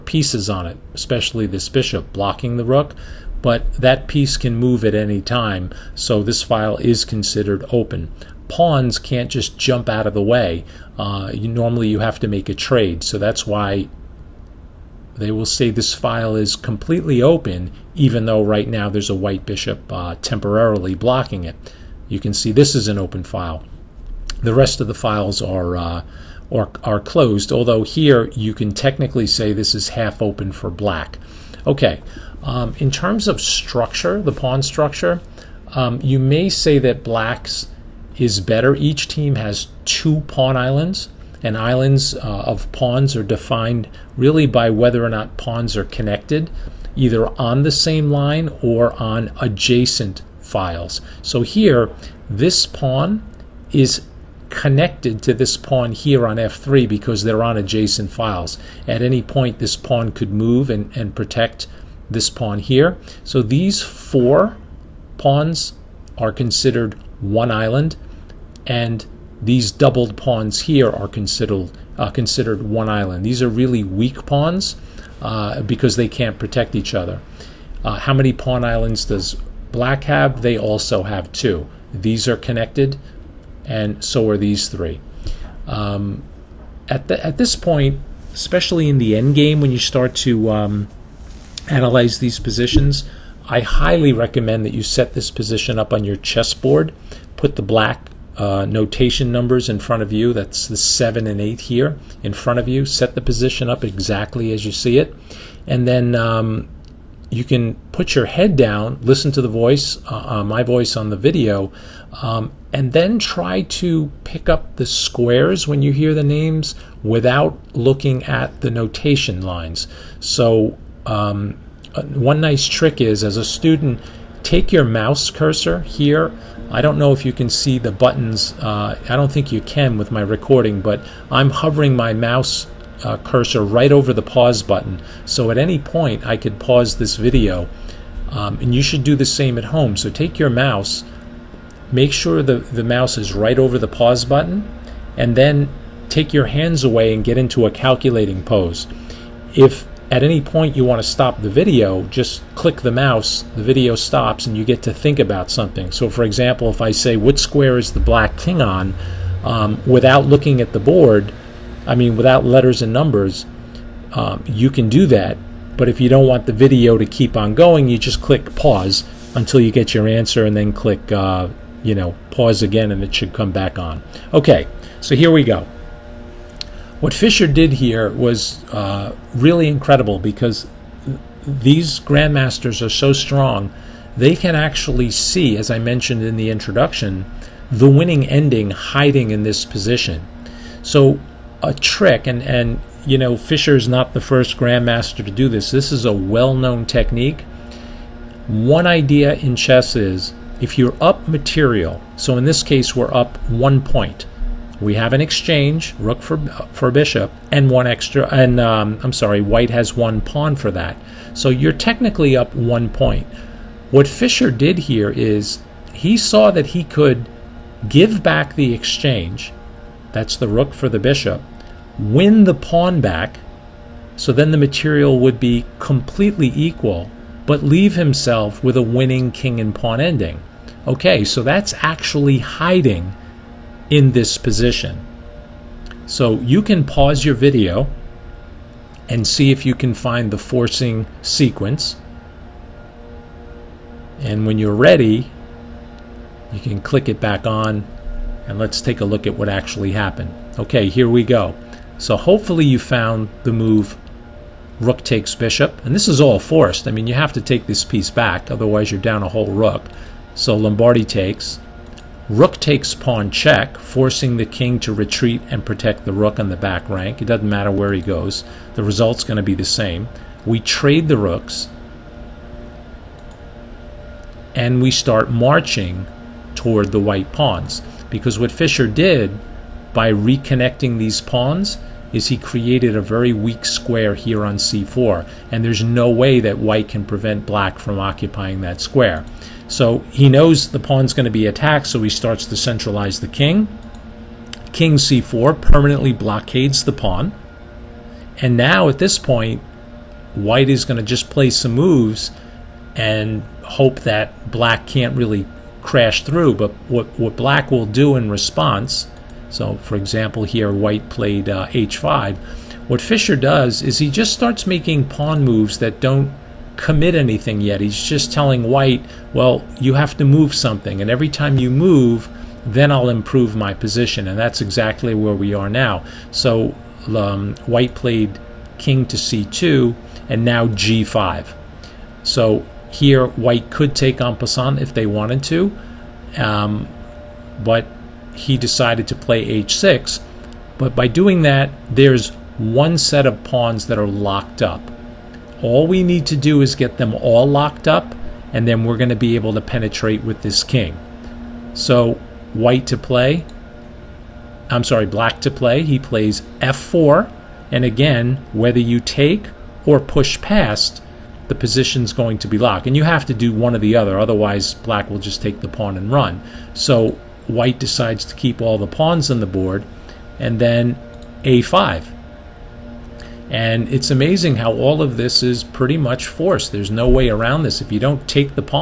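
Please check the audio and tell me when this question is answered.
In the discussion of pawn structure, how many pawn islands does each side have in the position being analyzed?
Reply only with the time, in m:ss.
0:39.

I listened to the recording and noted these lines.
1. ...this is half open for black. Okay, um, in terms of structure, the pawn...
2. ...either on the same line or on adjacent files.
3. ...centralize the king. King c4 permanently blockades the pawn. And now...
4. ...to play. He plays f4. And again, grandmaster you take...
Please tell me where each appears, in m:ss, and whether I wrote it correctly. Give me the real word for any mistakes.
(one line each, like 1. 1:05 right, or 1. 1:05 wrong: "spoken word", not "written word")
1. 0:29 right
2. 0:46 right
3. 4:52 right
4. 5:55 wrong: "whether", not "grandmaster".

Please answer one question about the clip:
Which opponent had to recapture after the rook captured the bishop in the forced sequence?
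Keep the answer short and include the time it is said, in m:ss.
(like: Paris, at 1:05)
Lombardy, at 4:20.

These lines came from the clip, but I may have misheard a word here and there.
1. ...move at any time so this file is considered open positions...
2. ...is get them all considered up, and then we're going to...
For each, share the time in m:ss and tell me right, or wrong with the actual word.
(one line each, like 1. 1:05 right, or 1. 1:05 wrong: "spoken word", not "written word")
1. 0:04 wrong: "pawns", not "positions"
2. 5:46 wrong: "locked", not "considered".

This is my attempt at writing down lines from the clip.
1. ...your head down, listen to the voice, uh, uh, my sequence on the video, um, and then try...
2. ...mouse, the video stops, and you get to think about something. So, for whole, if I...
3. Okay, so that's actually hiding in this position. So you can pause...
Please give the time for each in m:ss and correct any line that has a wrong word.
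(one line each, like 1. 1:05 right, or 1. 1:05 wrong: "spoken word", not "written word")
1. 1:48 wrong: "voice", not "sequence"
2. 2:32 wrong: "example", not "whole"
3. 3:50 right.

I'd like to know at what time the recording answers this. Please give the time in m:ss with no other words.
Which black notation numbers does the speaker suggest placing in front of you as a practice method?
1:40.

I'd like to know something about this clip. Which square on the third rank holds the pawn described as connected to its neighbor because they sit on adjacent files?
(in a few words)
f3.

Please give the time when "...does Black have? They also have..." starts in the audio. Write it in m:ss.
1:19.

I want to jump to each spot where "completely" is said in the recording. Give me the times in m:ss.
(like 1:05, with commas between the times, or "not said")
0:16, 3:45.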